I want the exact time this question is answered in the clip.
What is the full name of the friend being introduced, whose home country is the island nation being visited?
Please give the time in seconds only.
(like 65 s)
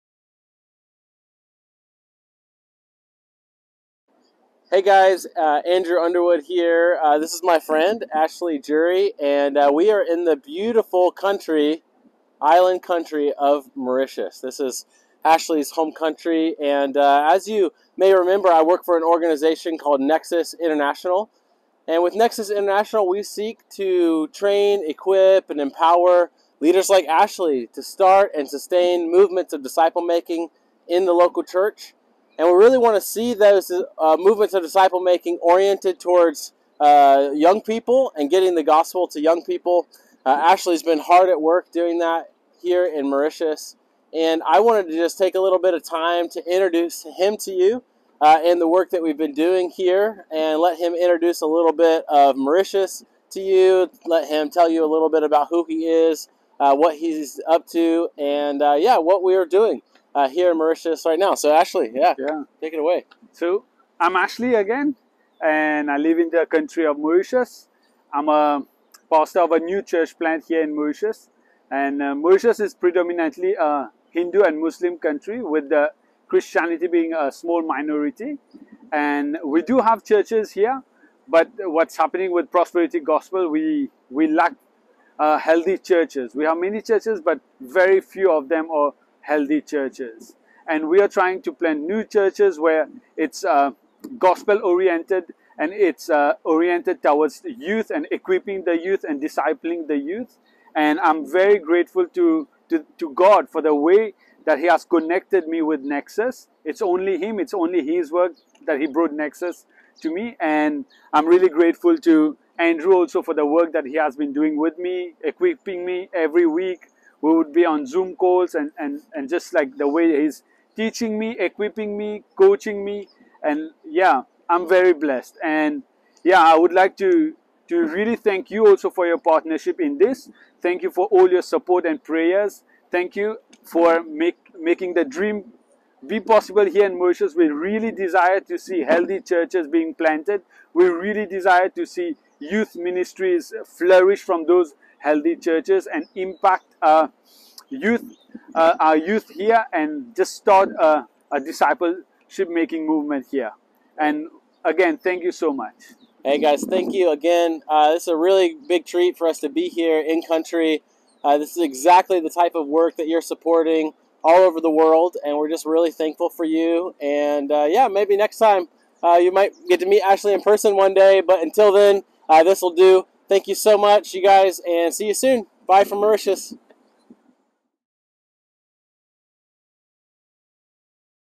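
8 s.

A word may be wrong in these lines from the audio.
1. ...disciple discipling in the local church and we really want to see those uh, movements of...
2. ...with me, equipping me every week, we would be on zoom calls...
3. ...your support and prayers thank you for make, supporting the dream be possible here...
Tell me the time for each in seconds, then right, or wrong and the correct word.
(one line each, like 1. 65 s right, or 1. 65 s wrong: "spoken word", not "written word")
1. 29 s wrong: "making", not "discipling"
2. 114 s right
3. 131 s wrong: "making", not "supporting".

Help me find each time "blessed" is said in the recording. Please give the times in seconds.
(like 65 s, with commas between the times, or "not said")
124 s.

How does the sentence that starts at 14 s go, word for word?
This is Ashley's home country, and uh, as you may remember, I work for an organization called Nexus International.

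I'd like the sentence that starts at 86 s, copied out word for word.
We have many churches, but very few of them are healthy churches.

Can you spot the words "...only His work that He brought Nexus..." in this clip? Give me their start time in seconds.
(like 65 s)
107 s.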